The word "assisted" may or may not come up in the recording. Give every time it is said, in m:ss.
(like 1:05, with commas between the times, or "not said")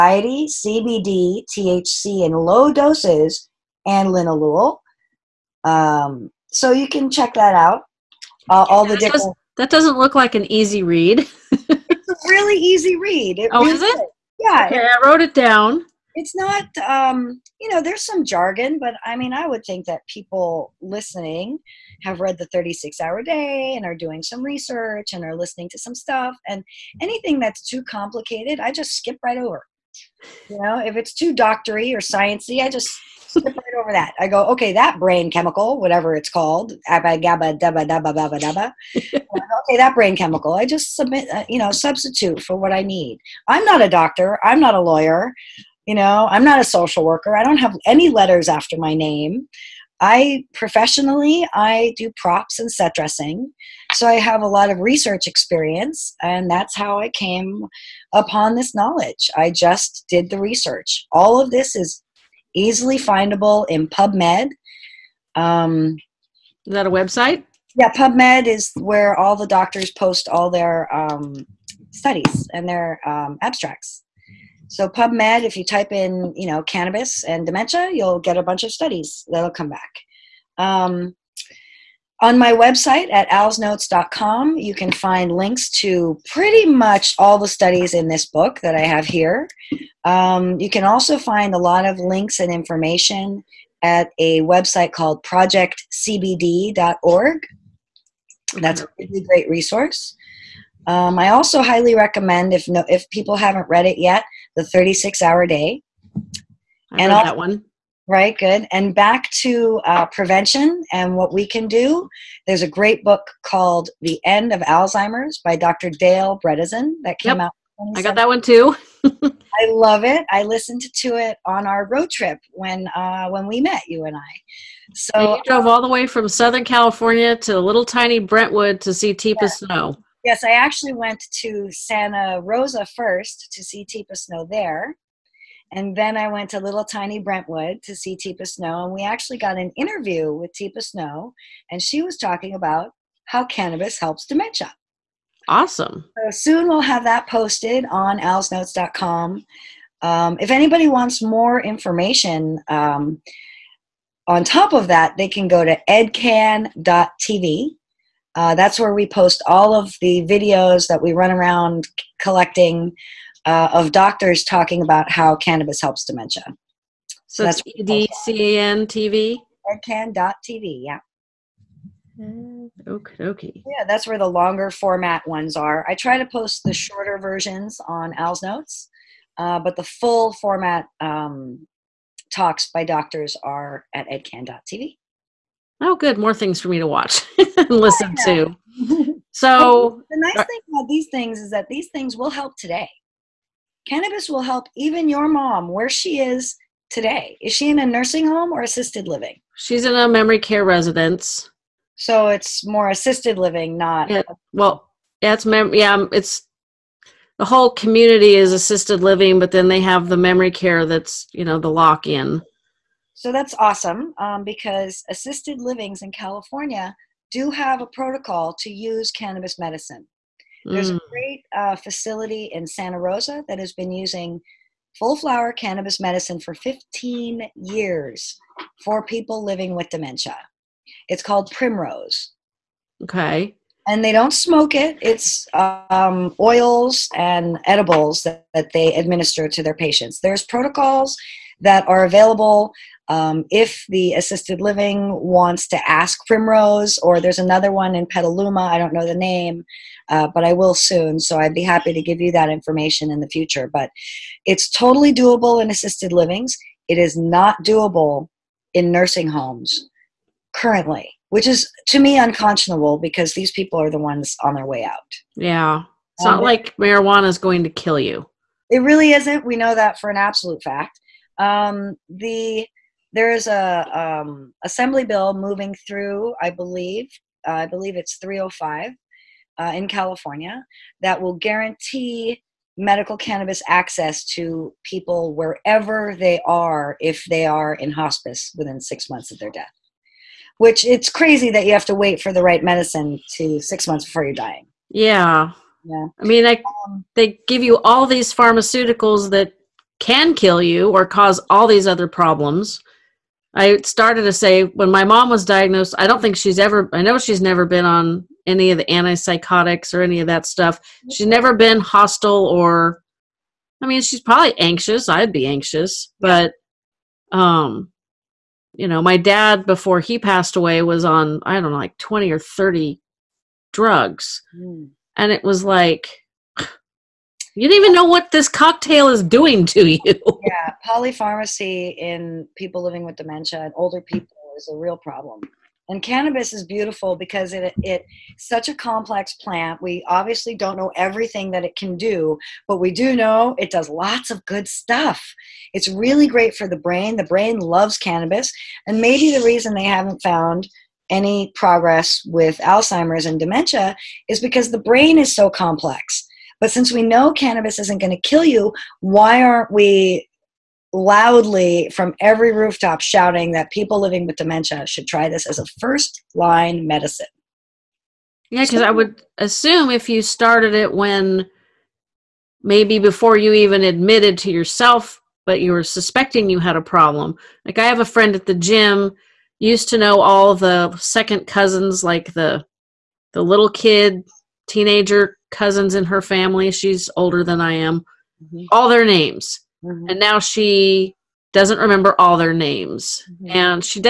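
3:18, 3:22, 3:28, 3:35, 4:04, 4:15.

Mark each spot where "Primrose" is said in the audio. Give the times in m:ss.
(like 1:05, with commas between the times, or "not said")
3:51, 4:06.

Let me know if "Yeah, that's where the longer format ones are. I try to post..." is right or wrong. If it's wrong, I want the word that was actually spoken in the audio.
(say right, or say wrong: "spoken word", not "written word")
right.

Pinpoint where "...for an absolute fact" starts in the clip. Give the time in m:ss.
4:29.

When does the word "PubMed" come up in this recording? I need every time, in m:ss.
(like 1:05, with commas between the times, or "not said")
1:03, 1:07, 1:14.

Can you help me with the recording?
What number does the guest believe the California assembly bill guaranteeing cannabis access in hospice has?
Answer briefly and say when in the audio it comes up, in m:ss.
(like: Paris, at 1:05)
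305, at 4:38.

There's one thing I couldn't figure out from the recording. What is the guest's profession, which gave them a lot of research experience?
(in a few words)
Props and set dressing.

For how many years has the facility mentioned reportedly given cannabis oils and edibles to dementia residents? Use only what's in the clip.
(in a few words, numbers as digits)
15.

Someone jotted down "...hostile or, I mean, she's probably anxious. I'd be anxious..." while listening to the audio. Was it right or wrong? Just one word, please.
right.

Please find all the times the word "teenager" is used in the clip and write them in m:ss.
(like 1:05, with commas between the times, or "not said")
6:24.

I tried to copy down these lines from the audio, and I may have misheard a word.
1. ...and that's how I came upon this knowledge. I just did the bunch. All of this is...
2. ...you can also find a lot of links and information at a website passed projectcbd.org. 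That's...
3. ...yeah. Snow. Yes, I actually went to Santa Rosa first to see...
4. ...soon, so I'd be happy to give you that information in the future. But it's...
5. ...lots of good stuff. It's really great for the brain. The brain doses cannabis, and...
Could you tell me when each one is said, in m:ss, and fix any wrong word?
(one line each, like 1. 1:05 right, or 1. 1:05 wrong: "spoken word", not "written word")
1. 0:56 wrong: "research", not "bunch"
2. 1:30 wrong: "called", not "passed"
3. 2:09 right
4. 4:10 right
5. 5:43 wrong: "loves", not "doses".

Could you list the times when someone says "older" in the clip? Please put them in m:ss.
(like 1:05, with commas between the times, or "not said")
5:33, 6:27.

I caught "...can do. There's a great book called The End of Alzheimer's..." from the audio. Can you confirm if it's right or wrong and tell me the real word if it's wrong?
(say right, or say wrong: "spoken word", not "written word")
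right.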